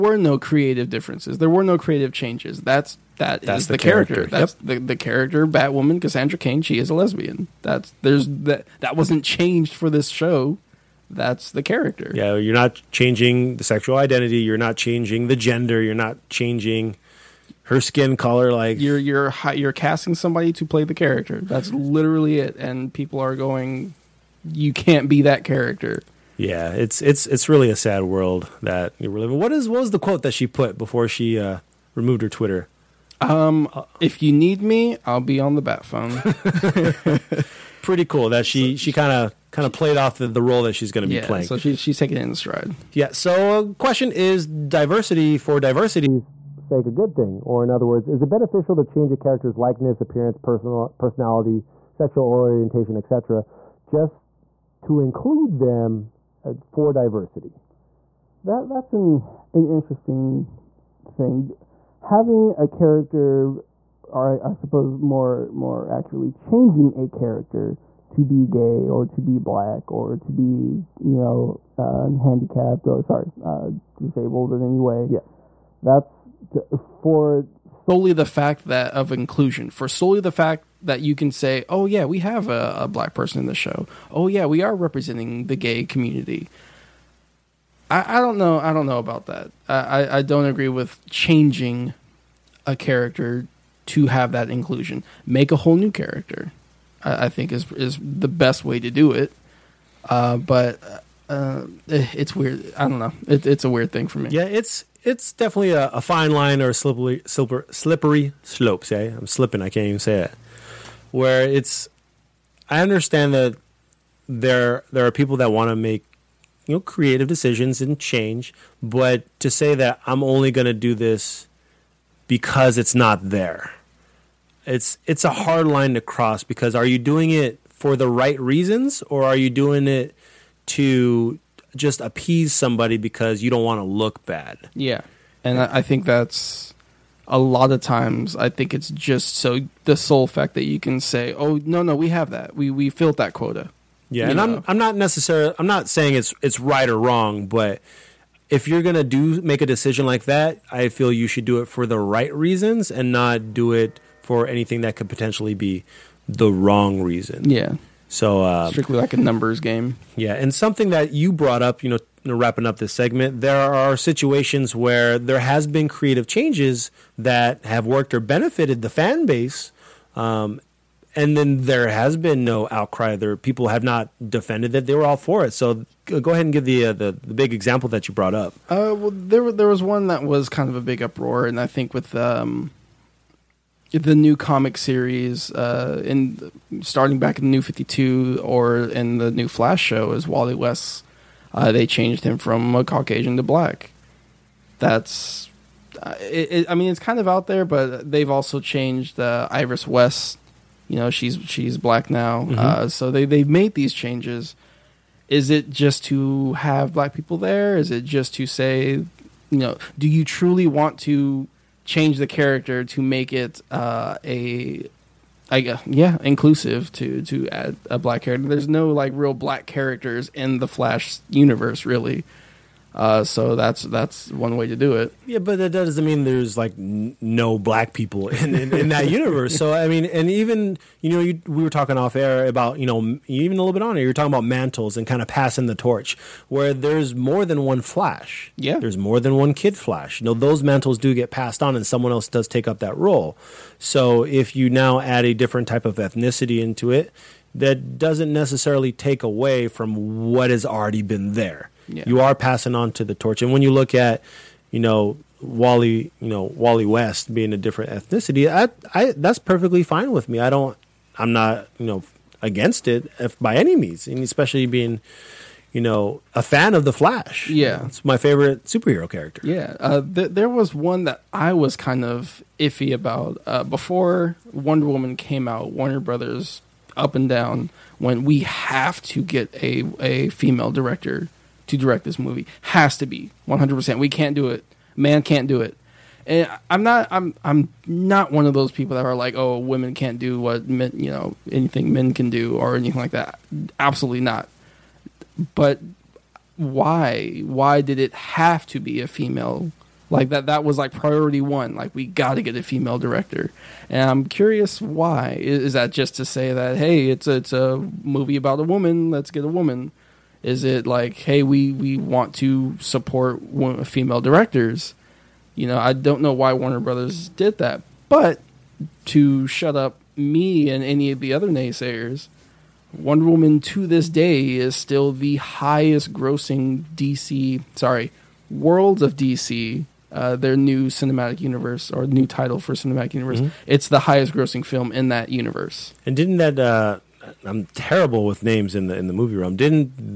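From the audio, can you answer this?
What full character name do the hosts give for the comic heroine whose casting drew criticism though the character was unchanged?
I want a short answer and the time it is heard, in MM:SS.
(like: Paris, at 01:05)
Cassandra Kane, at 00:06.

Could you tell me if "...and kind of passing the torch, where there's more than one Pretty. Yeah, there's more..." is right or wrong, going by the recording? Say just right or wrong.
wrong.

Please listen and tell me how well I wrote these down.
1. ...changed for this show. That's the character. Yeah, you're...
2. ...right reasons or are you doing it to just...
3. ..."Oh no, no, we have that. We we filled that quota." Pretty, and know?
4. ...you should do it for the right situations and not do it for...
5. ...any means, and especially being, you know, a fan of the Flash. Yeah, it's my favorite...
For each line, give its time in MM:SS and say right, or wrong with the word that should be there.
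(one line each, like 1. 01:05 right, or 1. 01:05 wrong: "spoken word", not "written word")
1. 00:09 right
2. 02:08 right
3. 02:21 wrong: "Yeah", not "Pretty"
4. 02:31 wrong: "reasons", not "situations"
5. 04:23 right.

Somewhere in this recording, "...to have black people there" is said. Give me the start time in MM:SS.
03:26.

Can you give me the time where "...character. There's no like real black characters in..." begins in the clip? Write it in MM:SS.
03:38.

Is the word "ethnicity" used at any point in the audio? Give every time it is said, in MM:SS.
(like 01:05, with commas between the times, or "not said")
04:05, 04:17.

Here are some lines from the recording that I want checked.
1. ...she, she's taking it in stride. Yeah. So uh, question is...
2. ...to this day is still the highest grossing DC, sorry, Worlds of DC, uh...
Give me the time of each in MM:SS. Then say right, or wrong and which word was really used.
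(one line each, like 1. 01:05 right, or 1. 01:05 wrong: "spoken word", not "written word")
1. 00:41 right
2. 05:23 right.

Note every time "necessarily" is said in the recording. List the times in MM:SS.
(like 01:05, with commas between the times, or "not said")
02:24, 04:08.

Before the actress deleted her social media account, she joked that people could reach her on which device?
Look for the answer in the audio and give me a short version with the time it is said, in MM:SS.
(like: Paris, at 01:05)
The bat phone, at 00:35.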